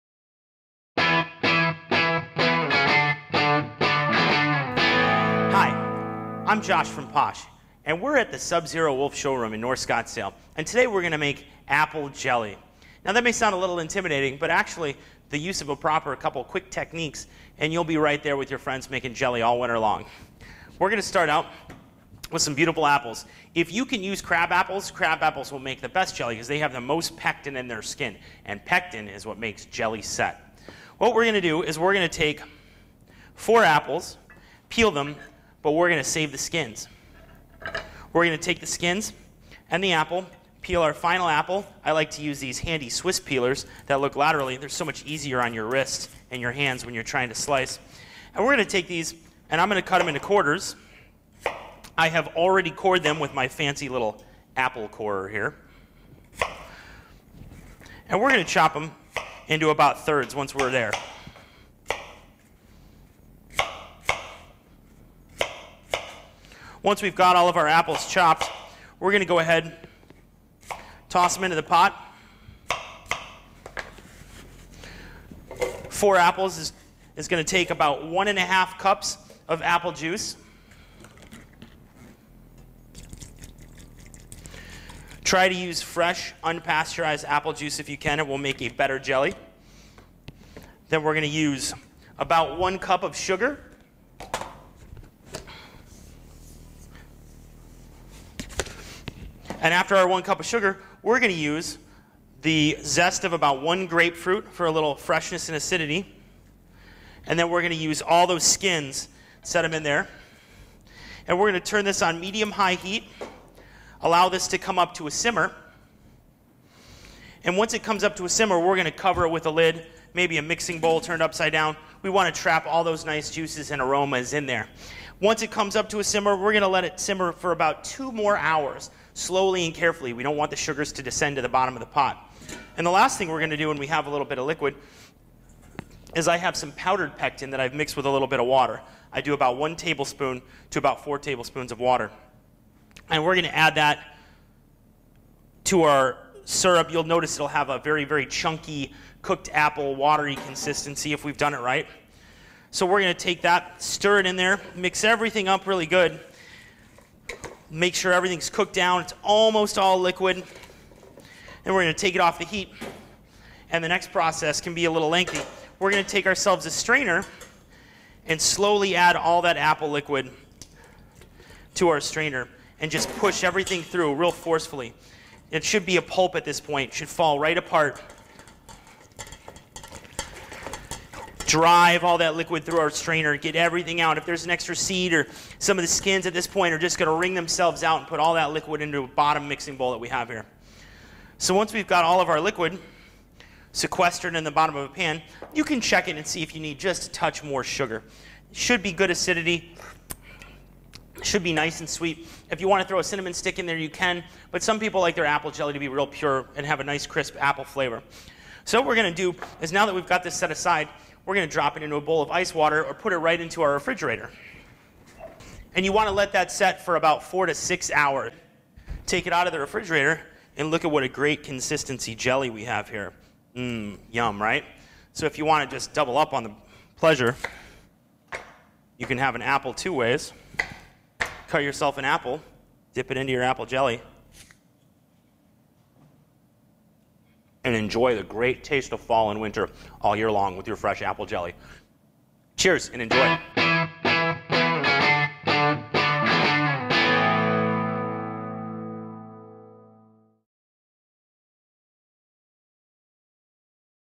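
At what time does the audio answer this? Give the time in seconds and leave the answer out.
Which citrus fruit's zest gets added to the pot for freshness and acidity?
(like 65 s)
103 s.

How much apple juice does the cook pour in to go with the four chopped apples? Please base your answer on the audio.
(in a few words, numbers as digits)
1.5 cups.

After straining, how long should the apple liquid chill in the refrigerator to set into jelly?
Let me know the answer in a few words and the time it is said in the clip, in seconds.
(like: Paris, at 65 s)
4 to 6 hours, at 217 s.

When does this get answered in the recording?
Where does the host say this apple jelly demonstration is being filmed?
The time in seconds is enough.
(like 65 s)
8 s.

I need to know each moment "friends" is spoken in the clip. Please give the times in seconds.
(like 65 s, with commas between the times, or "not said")
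18 s.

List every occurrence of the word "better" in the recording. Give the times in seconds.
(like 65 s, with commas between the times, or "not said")
88 s.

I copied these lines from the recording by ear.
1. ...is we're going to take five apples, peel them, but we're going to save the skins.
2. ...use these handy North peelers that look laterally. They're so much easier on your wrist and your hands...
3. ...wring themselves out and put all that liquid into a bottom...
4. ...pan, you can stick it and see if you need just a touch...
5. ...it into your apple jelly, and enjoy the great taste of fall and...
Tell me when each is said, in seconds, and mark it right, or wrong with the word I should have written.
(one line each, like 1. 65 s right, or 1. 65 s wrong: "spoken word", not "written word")
1. 31 s wrong: "four", not "five"
2. 42 s wrong: "Swiss", not "North"
3. 187 s right
4. 194 s wrong: "check", not "stick"
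5. 233 s right.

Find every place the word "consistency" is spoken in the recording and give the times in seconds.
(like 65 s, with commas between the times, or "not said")
150 s, 221 s.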